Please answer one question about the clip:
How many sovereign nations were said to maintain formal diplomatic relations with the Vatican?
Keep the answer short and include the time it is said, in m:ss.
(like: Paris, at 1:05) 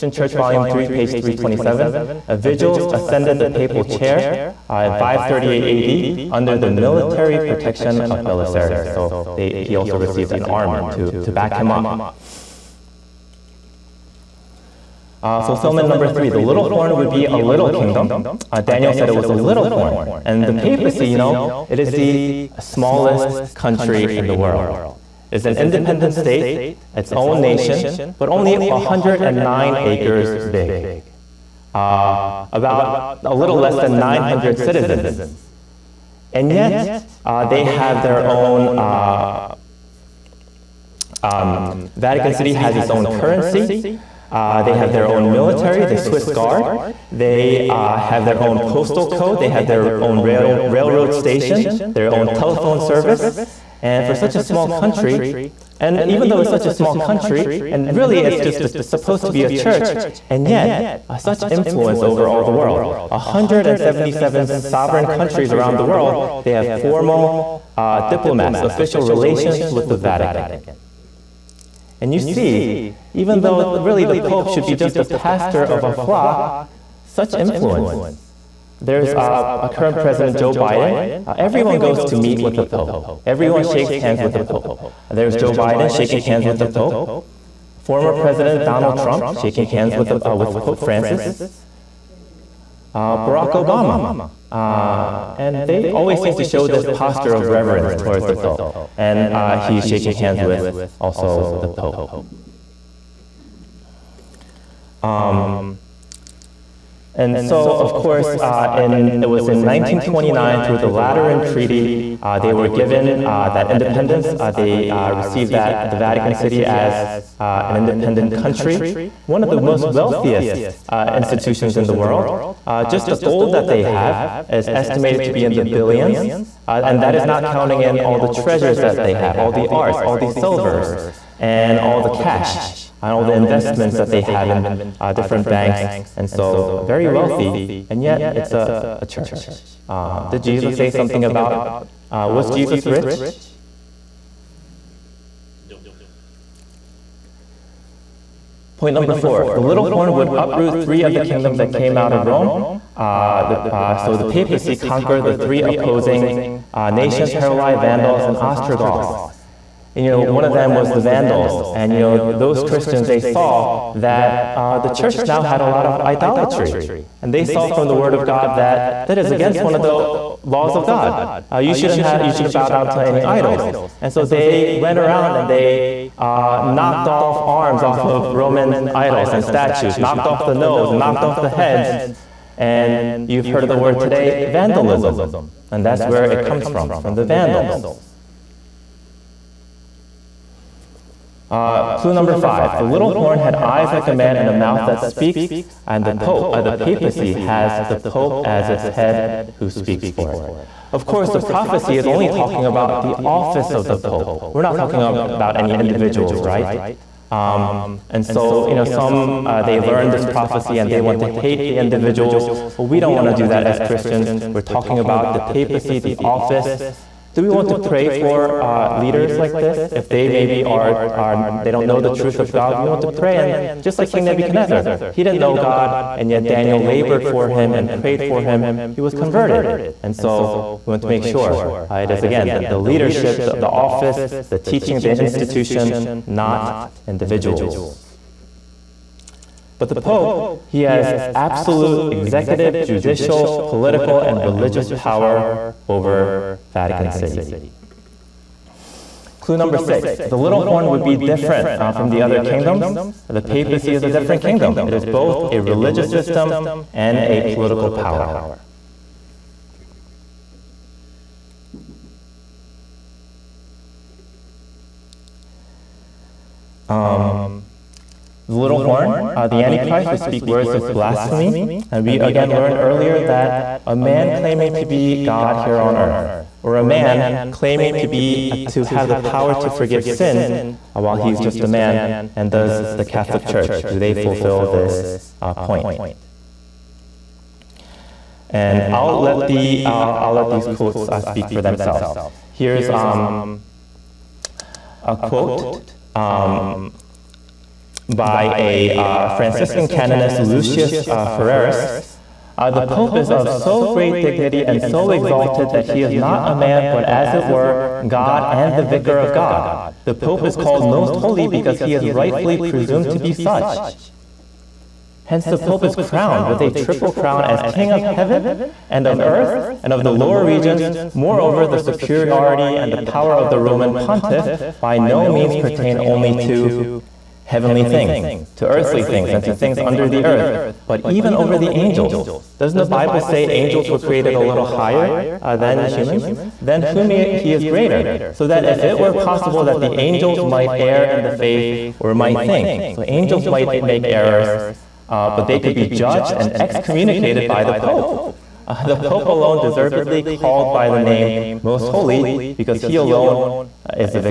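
177, at 1:03.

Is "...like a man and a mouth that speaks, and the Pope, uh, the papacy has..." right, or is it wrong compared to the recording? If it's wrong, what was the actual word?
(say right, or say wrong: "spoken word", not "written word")
right.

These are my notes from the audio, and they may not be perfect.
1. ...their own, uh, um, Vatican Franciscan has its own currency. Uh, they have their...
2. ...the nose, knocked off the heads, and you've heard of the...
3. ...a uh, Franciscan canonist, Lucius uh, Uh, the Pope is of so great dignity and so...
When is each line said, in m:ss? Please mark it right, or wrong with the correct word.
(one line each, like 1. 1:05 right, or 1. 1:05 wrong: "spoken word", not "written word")
1. 0:38 wrong: "City", not "Franciscan"
2. 3:00 right
3. 4:58 right.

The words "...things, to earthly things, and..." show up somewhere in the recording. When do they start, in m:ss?
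5:27.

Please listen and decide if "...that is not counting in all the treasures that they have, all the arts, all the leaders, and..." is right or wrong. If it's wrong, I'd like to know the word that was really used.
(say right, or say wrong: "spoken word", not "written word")
wrong: "silvers", not "leaders".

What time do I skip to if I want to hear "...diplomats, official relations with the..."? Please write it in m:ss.
1:08.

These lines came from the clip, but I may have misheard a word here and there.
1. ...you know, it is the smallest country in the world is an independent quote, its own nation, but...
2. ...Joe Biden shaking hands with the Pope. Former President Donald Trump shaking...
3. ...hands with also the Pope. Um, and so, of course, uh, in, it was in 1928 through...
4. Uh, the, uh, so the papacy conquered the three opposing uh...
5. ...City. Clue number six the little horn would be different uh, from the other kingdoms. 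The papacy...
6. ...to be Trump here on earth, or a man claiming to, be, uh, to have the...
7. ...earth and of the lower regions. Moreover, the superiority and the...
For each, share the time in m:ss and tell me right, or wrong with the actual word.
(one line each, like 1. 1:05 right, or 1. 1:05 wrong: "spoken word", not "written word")
1. 0:21 wrong: "state", not "quote"
2. 1:25 right
3. 1:40 wrong: "1929", not "1928"
4. 2:32 right
5. 4:07 right
6. 4:34 wrong: "God", not "Trump"
7. 5:19 right.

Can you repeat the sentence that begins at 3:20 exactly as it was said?
Of course, the prophecy is only talking about the office of the Pope.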